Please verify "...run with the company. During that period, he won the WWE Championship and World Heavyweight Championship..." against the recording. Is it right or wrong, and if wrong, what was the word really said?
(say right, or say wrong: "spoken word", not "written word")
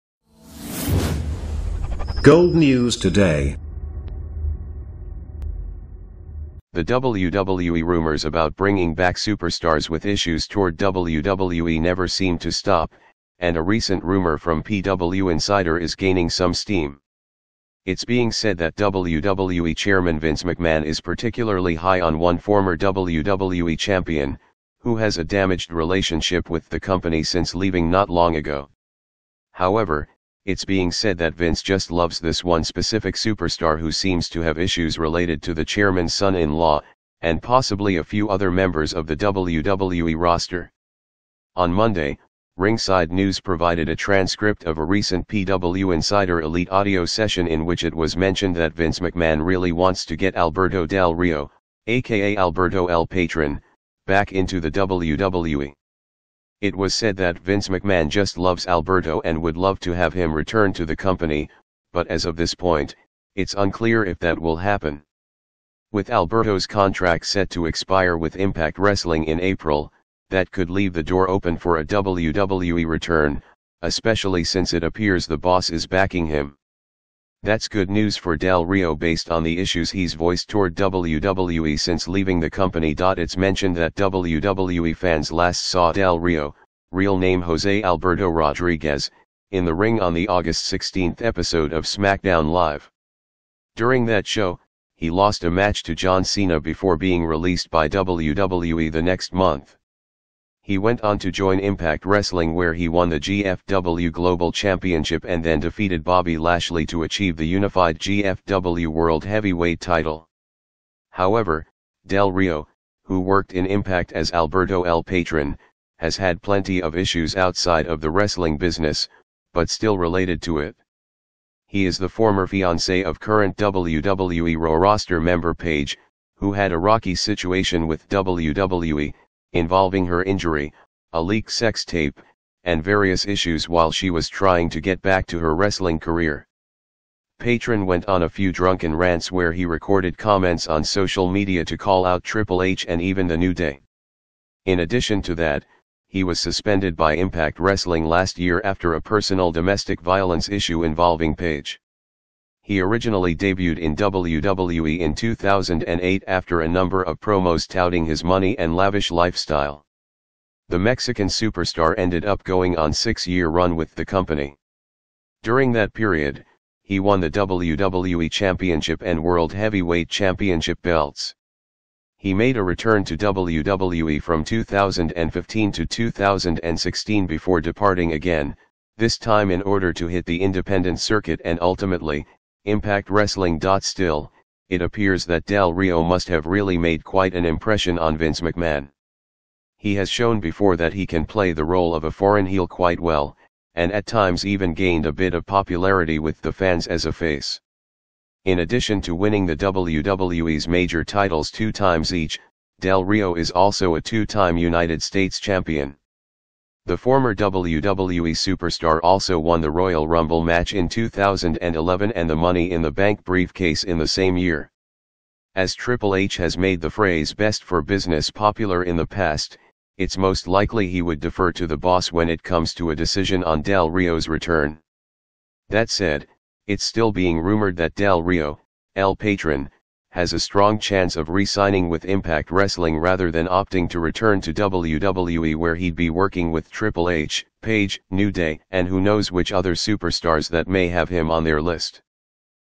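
right.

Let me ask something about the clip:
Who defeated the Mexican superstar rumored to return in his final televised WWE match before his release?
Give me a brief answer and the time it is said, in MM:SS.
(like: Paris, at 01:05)
John Cena, at 01:35.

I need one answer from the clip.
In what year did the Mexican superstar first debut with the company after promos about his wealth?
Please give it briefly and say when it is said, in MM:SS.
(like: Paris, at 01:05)
2008, at 02:35.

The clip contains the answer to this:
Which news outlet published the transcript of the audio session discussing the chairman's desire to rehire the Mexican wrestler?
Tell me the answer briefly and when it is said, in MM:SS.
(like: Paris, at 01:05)
Ringside News, at 00:42.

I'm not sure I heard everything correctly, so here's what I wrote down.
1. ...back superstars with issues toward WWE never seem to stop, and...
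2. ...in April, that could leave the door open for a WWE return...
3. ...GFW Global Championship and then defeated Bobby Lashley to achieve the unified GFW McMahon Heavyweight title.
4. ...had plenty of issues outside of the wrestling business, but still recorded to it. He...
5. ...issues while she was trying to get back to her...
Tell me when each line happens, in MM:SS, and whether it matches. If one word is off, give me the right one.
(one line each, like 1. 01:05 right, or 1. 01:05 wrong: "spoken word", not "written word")
1. 00:08 right
2. 01:09 right
3. 01:43 wrong: "World", not "McMahon"
4. 01:56 wrong: "related", not "recorded"
5. 02:13 right.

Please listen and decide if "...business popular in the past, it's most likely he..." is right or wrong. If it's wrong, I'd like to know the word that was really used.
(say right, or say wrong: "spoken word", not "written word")
right.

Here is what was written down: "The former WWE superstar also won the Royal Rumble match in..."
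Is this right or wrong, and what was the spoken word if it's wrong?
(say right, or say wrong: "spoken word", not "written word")
right.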